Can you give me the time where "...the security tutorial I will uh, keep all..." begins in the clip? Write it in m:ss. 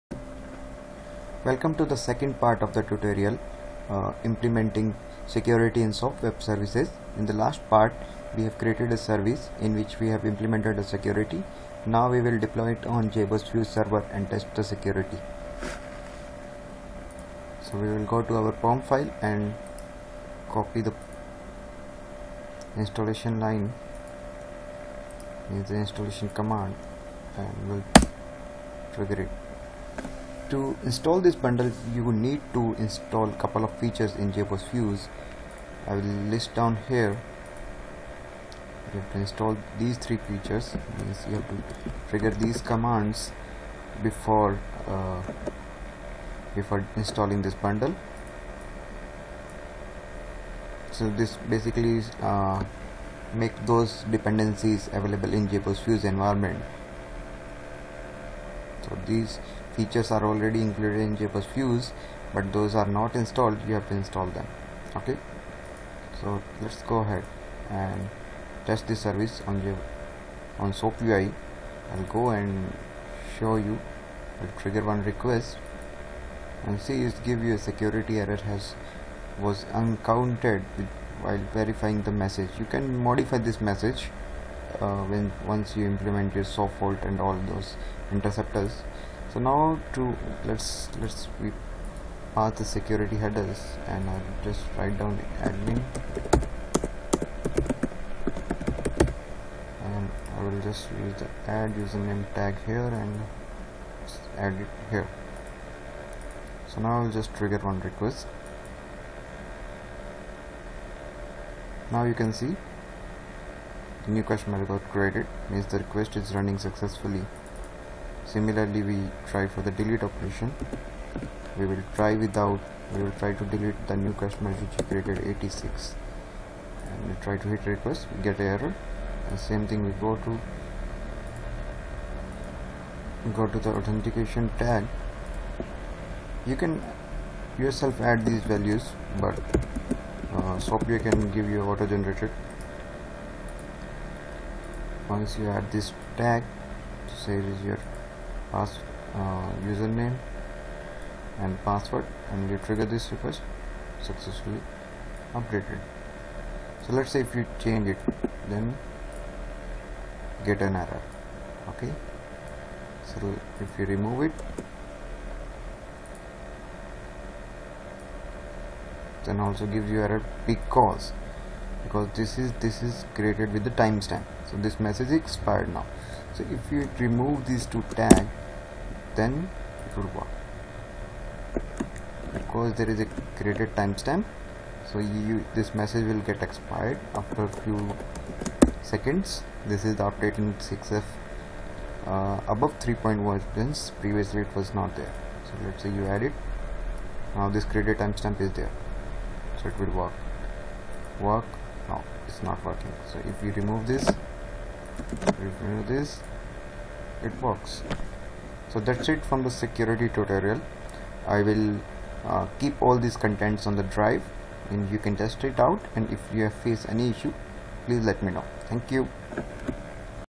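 3:29.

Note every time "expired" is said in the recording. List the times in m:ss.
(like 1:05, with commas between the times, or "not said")
2:55, 3:06.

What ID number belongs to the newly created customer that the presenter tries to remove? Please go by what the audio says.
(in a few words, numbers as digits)
86.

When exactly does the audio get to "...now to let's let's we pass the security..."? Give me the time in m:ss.
1:29.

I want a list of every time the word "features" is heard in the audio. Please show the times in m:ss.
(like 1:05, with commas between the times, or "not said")
0:33, 0:40, 0:59.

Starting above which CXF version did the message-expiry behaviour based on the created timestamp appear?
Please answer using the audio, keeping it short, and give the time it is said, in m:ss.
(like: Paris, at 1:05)
3.1, at 3:12.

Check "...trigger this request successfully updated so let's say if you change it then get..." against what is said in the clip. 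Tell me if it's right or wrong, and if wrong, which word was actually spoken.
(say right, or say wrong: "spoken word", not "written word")
right.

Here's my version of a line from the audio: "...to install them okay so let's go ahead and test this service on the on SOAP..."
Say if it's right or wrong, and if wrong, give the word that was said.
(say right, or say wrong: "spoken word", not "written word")
right.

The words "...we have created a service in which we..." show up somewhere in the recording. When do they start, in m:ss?
0:08.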